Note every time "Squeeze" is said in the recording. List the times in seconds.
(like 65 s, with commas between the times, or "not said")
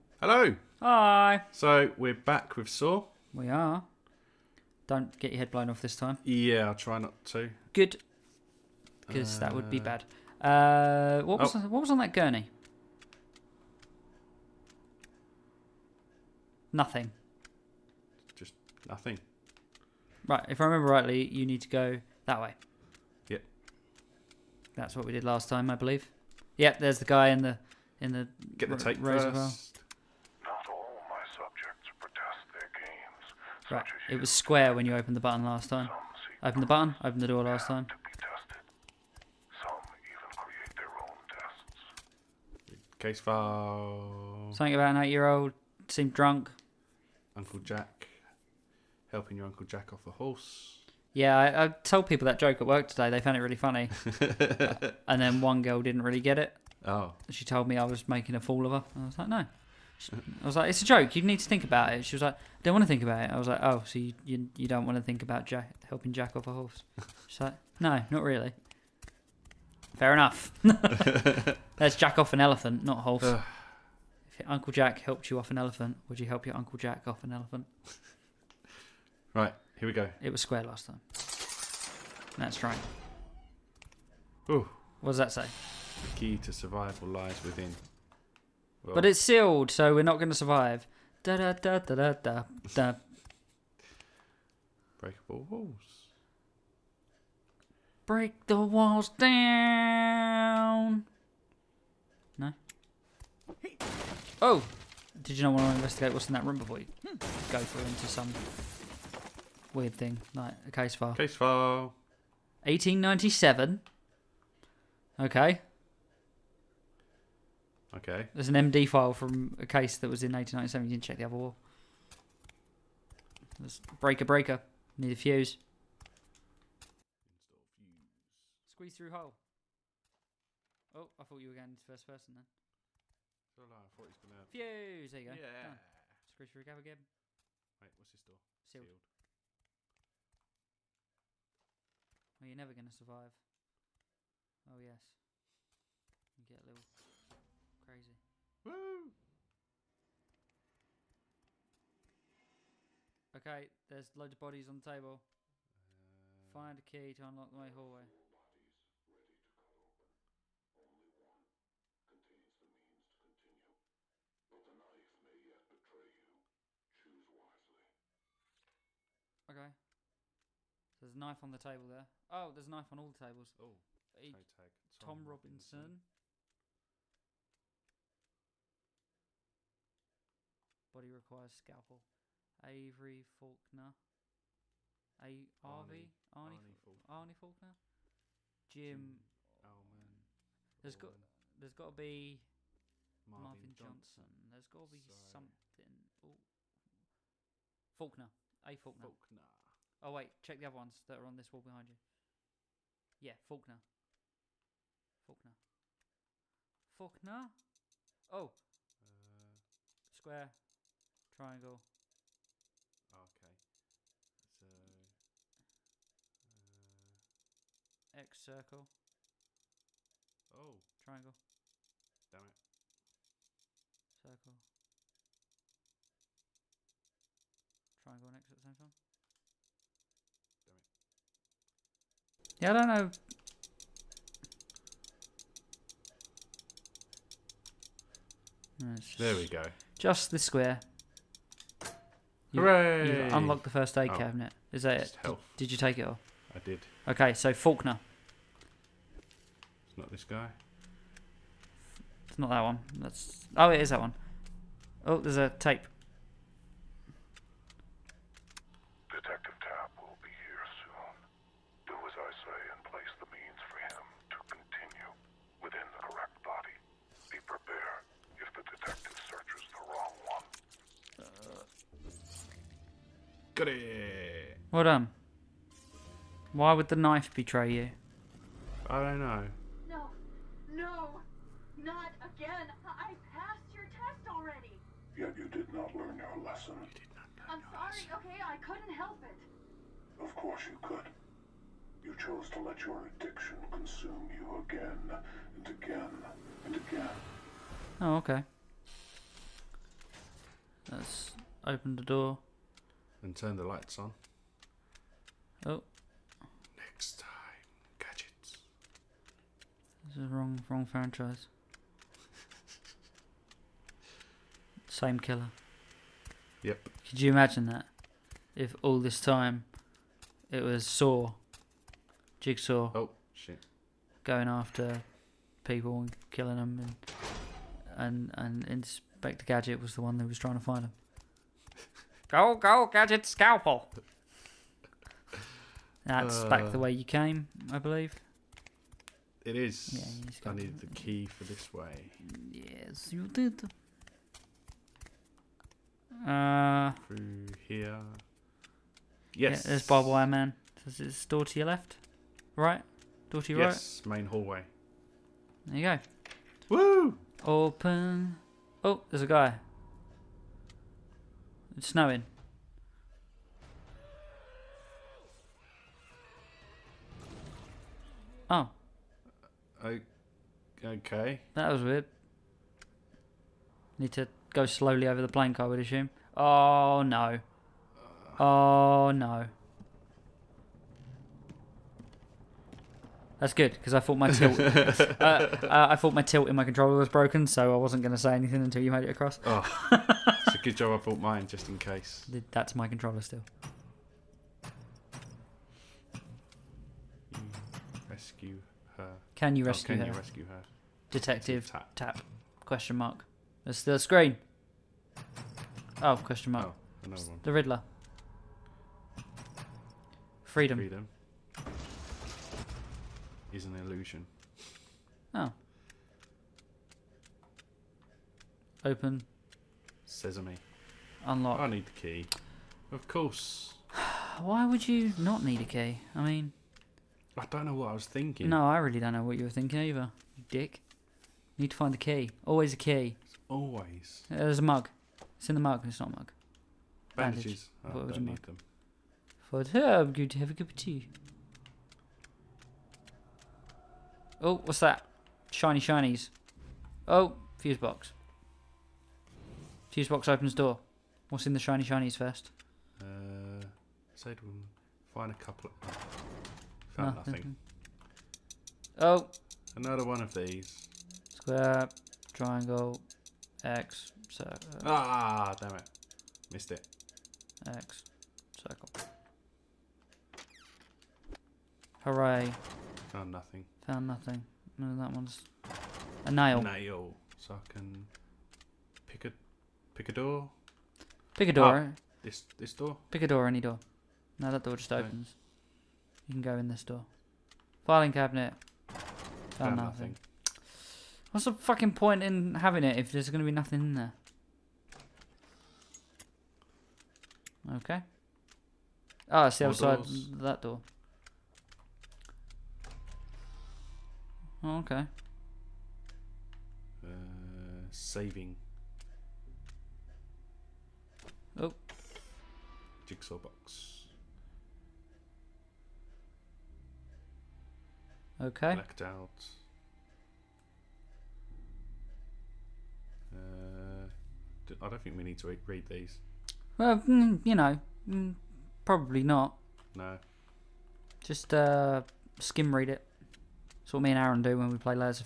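128 s, 136 s.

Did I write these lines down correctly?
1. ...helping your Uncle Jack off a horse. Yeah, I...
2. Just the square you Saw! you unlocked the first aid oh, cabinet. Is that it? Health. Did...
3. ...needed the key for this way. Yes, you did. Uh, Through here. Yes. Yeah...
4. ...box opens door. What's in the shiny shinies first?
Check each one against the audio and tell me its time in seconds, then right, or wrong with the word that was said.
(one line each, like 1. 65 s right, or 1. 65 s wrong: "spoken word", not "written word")
1. 49 s right
2. 239 s wrong: "Hooray", not "Saw"
3. 340 s right
4. 450 s right.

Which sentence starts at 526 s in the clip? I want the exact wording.
Well, mm, you know, mm, probably not.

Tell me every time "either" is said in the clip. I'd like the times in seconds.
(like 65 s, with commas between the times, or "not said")
429 s.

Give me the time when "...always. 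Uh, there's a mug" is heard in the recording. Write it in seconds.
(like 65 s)
433 s.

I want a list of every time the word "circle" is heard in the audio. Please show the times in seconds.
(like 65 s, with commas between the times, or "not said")
218 s, 224 s, 464 s, 468 s.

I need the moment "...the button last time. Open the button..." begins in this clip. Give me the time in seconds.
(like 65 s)
35 s.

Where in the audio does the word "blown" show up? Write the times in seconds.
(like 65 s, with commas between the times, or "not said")
5 s.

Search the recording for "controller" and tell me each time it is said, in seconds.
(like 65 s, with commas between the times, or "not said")
386 s, 392 s.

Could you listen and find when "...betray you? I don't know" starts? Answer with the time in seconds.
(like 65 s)
277 s.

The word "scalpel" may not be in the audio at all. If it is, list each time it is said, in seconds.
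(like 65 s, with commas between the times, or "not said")
181 s, 333 s.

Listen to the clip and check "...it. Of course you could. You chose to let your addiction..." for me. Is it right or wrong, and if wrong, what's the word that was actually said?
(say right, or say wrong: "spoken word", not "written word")
right.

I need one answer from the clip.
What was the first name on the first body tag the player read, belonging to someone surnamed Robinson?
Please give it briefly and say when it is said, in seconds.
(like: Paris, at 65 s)
Tom, at 174 s.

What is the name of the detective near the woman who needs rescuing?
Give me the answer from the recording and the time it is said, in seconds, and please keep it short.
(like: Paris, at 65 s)
Tapp, at 401 s.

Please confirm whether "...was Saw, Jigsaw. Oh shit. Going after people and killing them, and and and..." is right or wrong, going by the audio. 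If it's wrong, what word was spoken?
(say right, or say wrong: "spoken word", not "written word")
right.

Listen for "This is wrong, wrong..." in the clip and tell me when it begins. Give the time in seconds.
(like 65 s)
310 s.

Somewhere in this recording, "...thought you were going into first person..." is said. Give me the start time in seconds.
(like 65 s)
131 s.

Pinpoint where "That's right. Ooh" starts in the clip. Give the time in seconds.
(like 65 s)
82 s.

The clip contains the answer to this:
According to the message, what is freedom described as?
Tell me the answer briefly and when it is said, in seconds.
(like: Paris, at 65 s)
An illusion, at 413 s.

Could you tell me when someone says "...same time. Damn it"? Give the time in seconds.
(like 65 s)
228 s.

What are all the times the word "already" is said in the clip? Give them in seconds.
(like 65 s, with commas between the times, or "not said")
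284 s.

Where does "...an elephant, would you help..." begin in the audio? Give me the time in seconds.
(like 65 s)
75 s.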